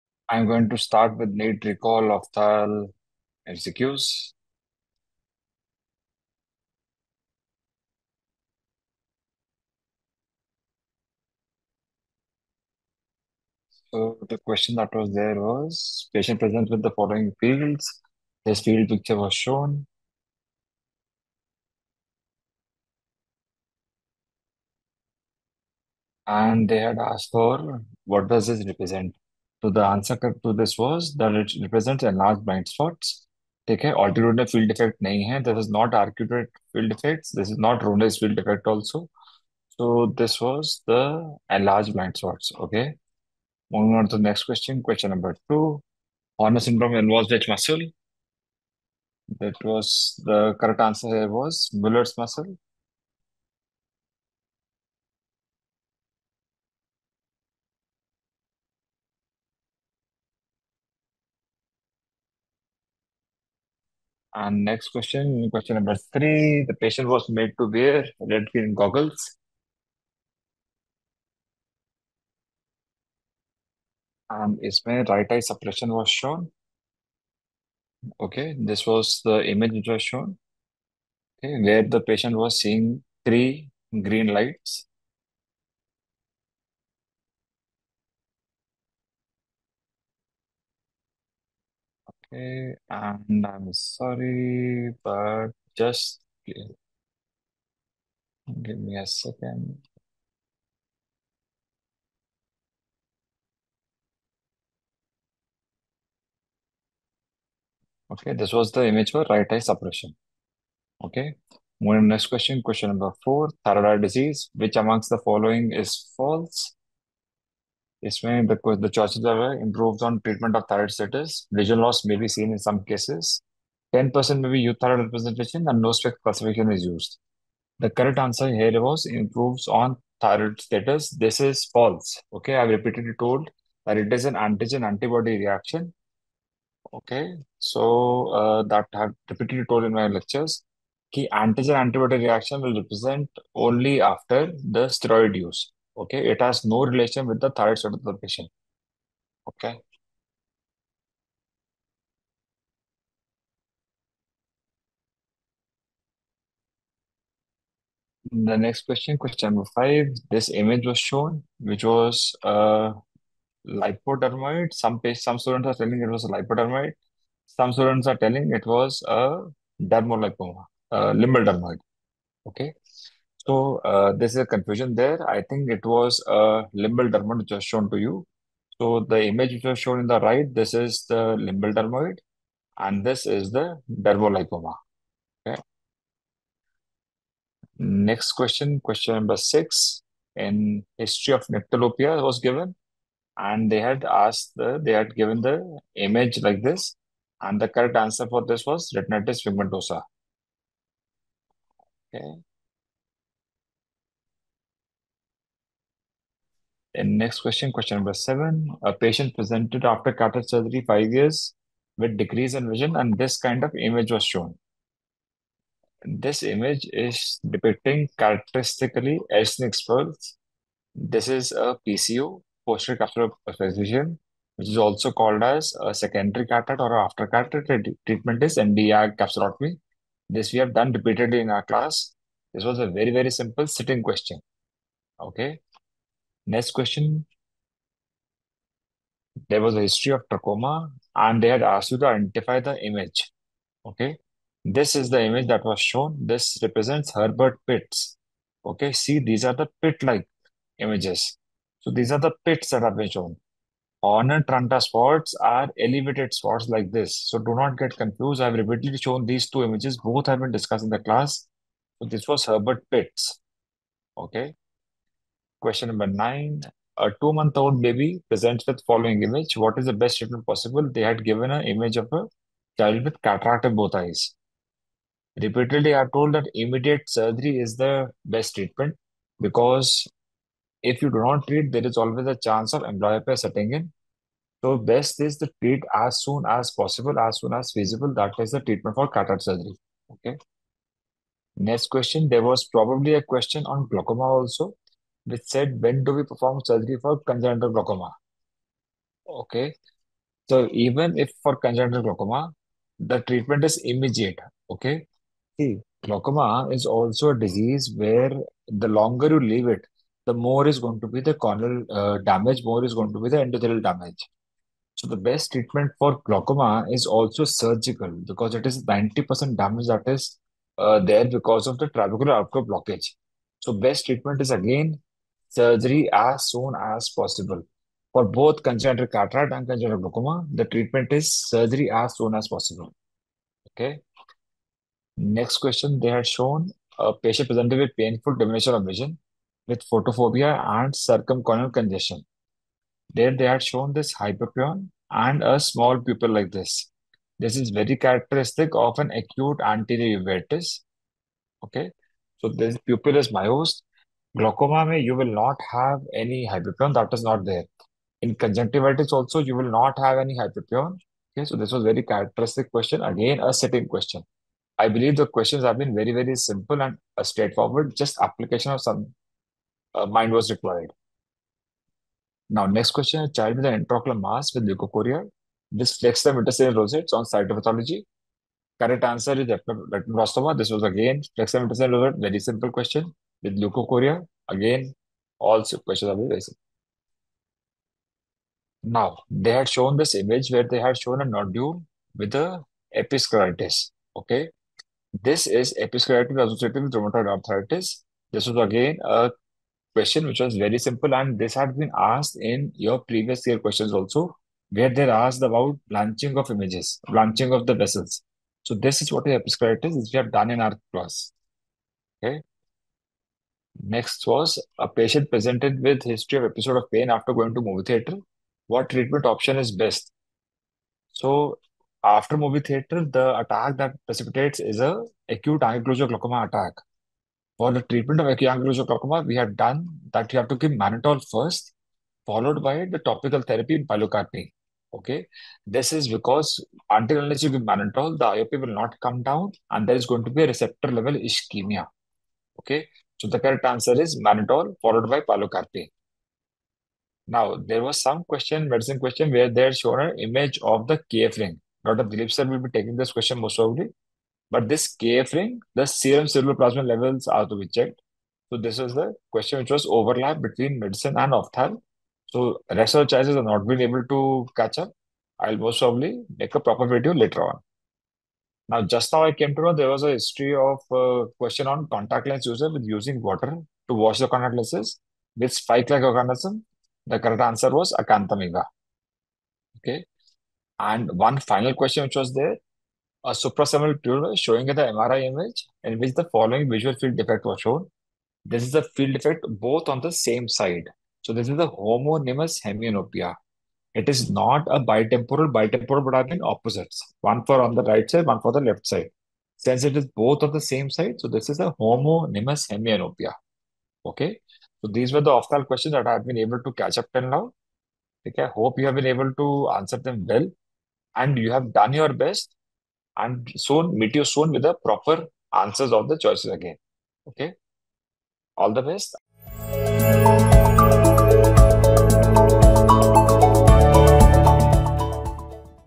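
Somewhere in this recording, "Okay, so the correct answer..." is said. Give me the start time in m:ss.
7:22.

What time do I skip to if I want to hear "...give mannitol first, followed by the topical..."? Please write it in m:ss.
7:10.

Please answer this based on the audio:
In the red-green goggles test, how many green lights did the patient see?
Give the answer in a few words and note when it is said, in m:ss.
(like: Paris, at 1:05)
3, at 1:23.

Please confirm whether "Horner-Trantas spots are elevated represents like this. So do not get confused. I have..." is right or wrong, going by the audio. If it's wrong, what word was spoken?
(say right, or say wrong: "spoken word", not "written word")
wrong: "spots", not "represents".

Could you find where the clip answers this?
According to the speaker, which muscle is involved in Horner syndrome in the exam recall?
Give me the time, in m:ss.
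0:51.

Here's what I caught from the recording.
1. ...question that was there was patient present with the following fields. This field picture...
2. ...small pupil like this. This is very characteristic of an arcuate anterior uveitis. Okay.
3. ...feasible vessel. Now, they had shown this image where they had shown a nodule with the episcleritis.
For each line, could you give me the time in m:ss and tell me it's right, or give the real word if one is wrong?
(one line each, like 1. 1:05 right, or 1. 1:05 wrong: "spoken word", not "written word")
1. 0:14 right
2. 5:45 wrong: "acute", not "arcuate"
3. 6:25 wrong: "questionable", not "feasible".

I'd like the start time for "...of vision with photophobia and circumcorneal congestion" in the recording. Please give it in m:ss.
5:38.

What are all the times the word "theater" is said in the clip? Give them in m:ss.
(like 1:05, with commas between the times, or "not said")
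6:57, 7:02.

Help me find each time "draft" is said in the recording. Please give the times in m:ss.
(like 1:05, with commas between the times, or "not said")
not said.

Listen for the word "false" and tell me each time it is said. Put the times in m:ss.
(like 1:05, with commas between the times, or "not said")
1:56, 2:11.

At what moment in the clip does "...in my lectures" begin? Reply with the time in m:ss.
2:19.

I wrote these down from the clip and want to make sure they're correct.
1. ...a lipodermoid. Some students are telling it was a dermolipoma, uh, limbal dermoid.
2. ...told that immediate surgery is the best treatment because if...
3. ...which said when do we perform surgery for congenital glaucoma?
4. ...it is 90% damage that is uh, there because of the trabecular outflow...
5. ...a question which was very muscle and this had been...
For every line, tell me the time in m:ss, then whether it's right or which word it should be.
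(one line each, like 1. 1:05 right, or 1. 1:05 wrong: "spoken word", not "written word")
1. 2:46 right
2. 4:36 right
3. 4:55 right
4. 5:18 right
5. 6:39 wrong: "simple", not "muscle".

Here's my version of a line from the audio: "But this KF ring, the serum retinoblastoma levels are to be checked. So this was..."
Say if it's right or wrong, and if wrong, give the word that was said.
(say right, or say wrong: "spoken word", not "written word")
wrong: "plasma", not "retinoblastoma".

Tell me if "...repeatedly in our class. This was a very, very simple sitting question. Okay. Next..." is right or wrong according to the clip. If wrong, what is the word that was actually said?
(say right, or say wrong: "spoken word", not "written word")
right.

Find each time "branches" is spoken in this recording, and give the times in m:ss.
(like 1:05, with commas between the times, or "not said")
not said.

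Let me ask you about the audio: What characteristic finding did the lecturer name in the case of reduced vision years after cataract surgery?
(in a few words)
Elschnig spurs.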